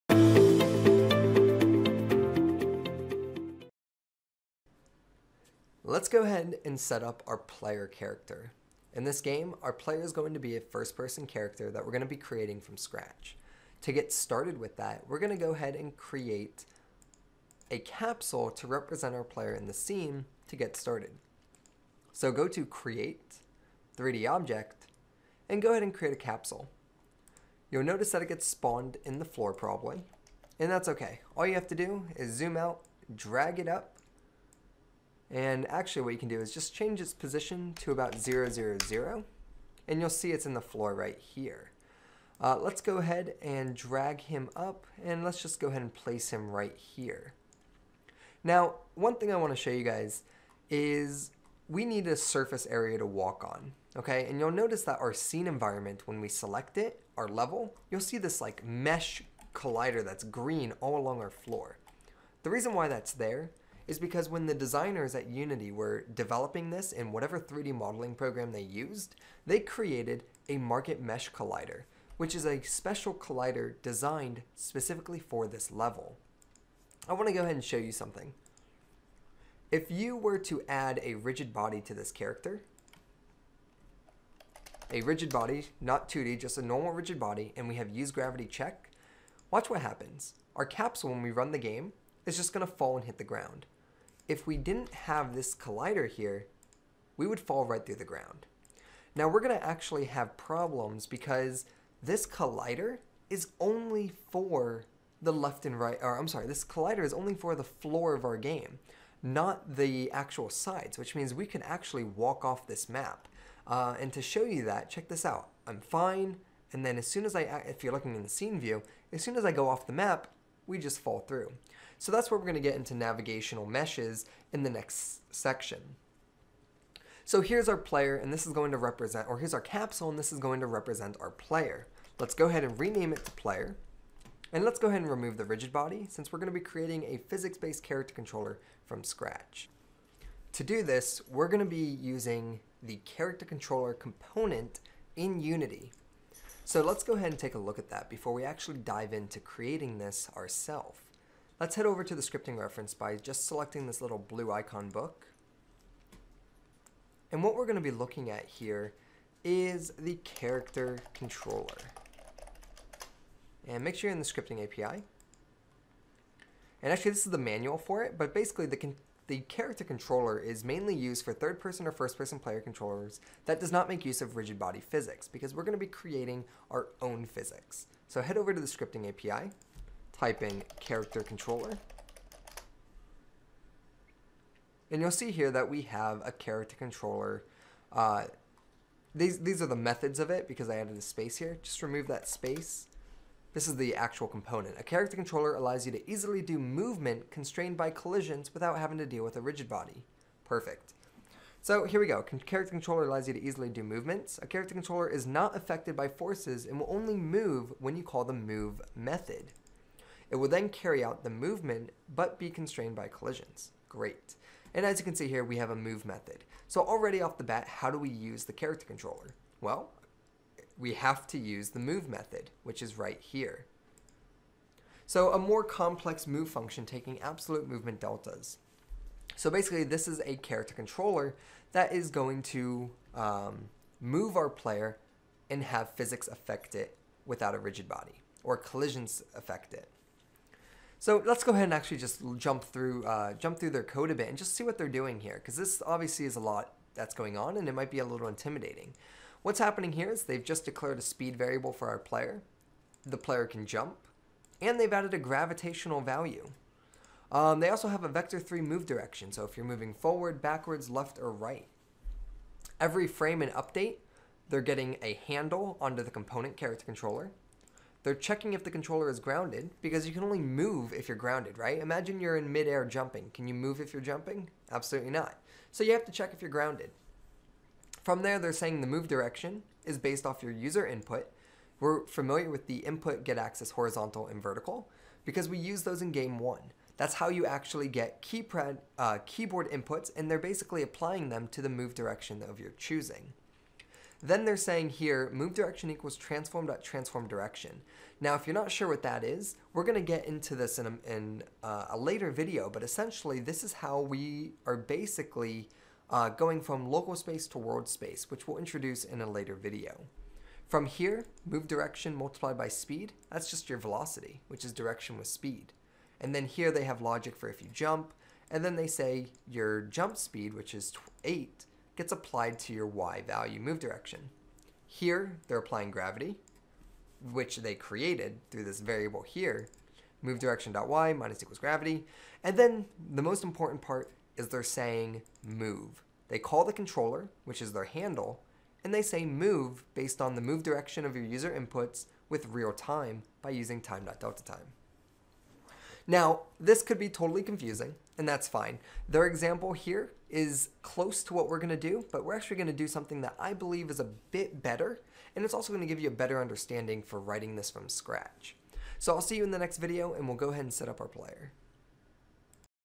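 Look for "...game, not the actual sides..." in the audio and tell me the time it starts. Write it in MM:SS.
01:48.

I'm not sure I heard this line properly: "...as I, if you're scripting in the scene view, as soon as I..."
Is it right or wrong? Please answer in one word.
wrong.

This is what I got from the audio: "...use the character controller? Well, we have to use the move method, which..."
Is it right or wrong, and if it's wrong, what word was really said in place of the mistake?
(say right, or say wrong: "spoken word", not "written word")
right.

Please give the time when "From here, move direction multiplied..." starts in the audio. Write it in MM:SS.
05:10.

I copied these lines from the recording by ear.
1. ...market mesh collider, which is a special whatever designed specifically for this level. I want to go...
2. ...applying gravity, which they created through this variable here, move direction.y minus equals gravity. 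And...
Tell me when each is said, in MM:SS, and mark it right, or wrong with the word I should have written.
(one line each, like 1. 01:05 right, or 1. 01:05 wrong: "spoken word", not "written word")
1. 01:10 wrong: "collider", not "whatever"
2. 05:25 right.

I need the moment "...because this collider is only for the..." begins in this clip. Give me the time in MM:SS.
01:41.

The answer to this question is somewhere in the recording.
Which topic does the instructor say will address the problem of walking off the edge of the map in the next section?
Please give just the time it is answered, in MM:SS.
02:02.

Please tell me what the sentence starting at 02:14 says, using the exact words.
And let's go ahead and remove the rigid body, since we're going to be creating a physics-based character controller from scratch.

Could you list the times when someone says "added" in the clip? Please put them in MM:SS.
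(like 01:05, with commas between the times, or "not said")
03:10, 04:14.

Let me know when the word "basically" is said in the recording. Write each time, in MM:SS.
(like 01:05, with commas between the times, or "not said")
02:48, 03:49, 04:50, 05:04.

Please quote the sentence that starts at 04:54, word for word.
Then they're saying here, move direction equals transform dot transform direction.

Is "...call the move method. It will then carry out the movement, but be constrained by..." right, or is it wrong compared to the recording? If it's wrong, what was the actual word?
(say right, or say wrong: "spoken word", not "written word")
right.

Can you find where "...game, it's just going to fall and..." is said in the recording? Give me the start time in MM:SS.
01:31.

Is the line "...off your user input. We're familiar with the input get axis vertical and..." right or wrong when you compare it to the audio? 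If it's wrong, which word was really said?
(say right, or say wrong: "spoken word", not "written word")
wrong: "horizontal", not "vertical".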